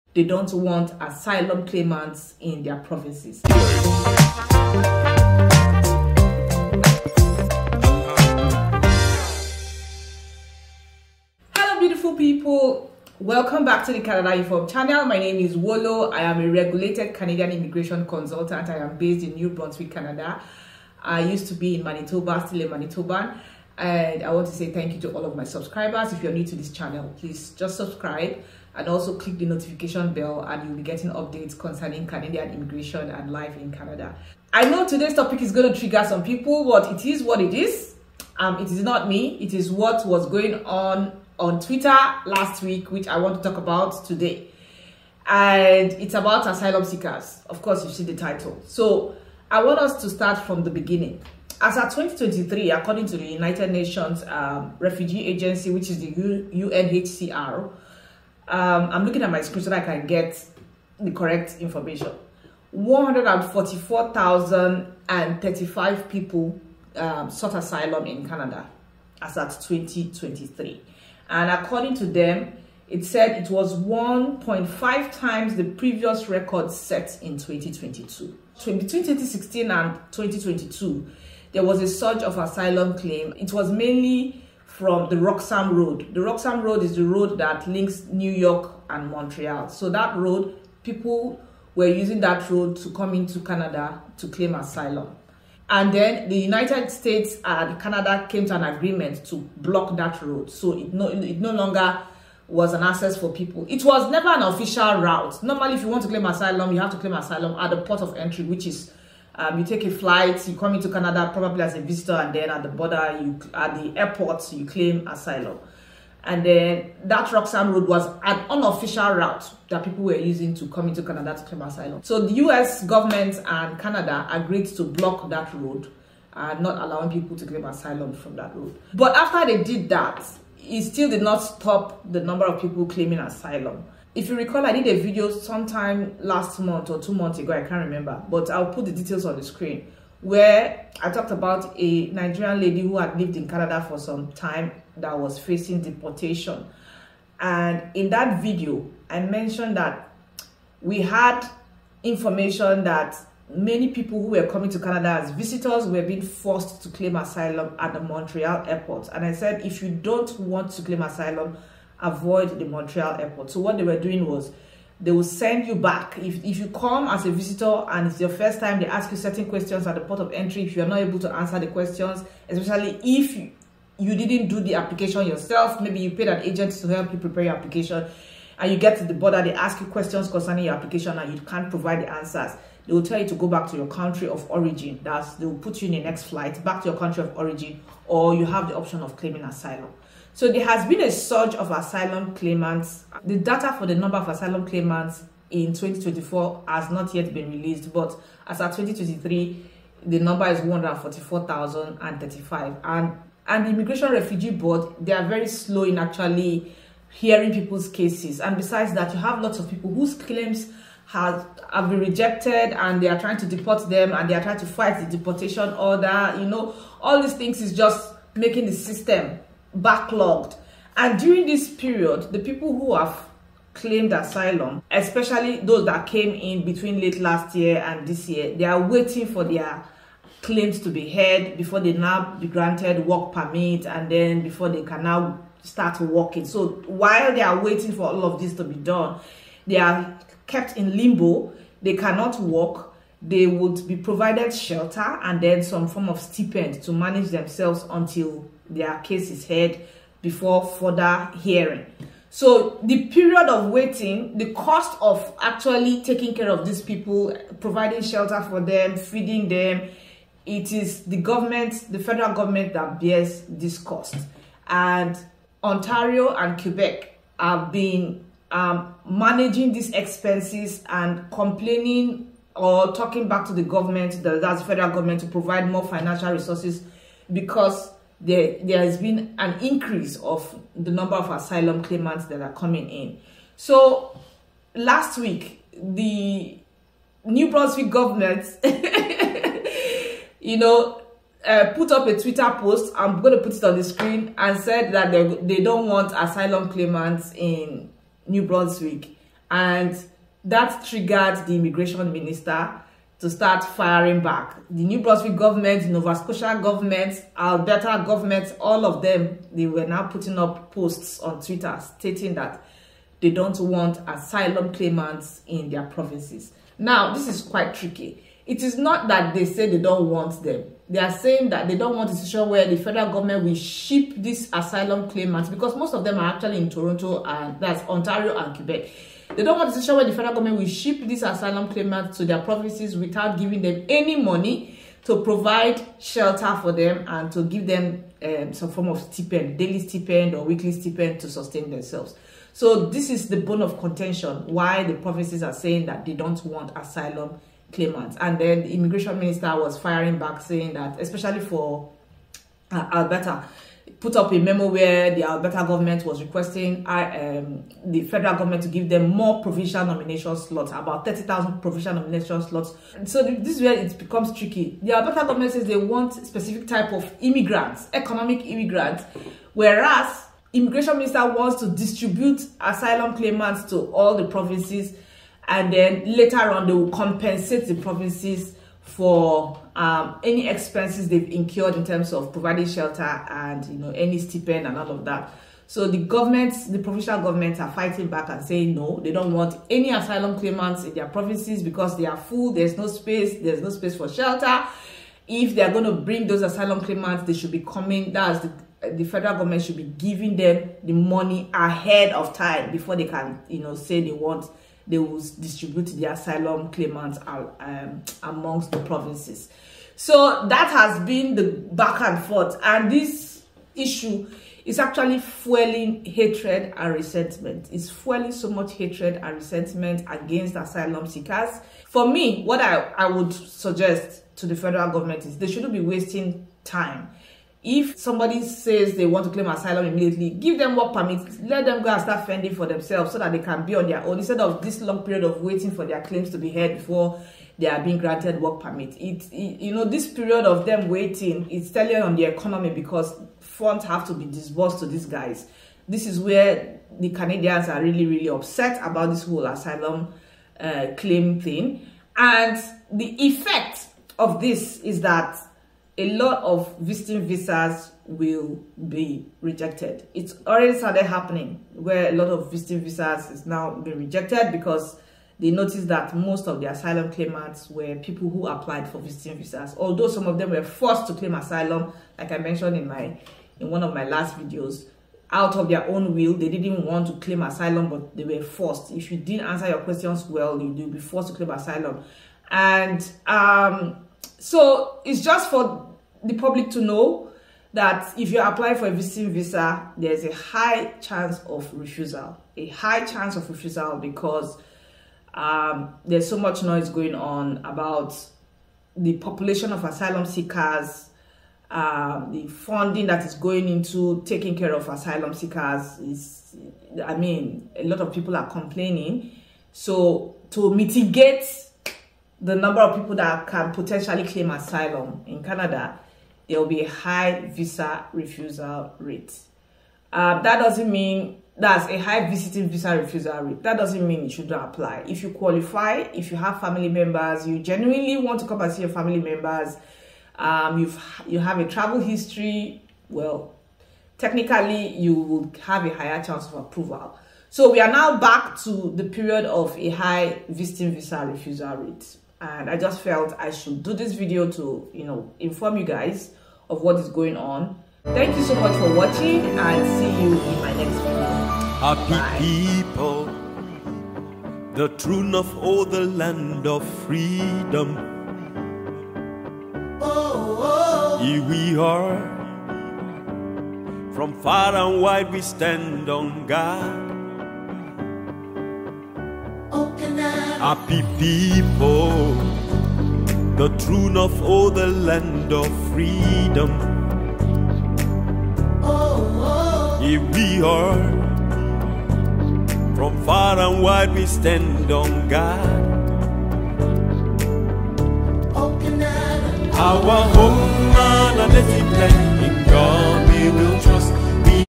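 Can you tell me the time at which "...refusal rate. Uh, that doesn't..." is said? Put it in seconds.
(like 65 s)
518 s.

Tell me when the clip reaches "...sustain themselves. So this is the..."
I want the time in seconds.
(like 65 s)
341 s.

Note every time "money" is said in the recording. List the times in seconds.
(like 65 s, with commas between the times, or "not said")
334 s, 400 s.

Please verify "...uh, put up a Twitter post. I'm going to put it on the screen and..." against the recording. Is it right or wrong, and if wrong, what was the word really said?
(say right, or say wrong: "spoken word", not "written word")
right.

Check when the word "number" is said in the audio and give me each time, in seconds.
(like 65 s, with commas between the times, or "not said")
132 s, 193 s, 200 s, 280 s, 512 s.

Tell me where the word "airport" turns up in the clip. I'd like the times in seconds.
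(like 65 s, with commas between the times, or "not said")
113 s, 158 s, 163 s.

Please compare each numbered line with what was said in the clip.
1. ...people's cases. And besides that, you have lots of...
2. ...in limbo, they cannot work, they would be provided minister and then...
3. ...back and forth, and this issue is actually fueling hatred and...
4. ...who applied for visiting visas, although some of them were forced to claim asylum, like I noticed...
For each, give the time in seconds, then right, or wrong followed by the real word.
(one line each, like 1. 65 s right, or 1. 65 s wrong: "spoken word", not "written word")
1. 207 s right
2. 240 s wrong: "shelter", not "minister"
3. 411 s right
4. 468 s wrong: "mentioned", not "noticed".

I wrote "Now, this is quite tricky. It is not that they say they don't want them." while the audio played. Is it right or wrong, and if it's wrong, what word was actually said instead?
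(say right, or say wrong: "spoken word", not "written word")
right.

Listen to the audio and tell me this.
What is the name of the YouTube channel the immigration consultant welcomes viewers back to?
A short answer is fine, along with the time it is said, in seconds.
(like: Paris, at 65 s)
Canada Infohub, at 14 s.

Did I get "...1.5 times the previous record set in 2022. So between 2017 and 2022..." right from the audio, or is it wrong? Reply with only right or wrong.
wrong.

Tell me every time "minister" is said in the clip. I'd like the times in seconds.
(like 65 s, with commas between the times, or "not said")
302 s, 349 s, 370 s.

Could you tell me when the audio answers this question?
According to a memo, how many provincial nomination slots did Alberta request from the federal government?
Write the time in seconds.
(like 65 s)
361 s.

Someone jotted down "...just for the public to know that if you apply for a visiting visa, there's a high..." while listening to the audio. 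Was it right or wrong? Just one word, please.
right.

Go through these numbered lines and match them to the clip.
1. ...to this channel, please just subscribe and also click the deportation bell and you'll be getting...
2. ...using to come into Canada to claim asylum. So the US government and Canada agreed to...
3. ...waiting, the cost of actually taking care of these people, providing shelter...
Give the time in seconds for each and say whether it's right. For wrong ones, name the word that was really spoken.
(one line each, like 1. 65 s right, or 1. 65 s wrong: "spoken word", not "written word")
1. 26 s wrong: "notification", not "deportation"
2. 120 s right
3. 253 s right.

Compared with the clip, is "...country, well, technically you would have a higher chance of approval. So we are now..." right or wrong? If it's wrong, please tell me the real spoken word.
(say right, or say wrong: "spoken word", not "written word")
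wrong: "history", not "country".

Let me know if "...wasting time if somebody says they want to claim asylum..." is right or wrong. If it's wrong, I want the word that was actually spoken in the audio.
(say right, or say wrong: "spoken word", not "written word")
right.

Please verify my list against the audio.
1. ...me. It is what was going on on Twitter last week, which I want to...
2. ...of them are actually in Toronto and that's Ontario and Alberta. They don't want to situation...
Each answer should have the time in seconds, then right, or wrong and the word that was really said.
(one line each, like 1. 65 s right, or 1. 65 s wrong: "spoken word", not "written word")
1. 39 s right
2. 325 s wrong: "Quebec", not "Alberta".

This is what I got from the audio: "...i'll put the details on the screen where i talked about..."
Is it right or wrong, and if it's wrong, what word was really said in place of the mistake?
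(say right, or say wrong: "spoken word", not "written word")
right.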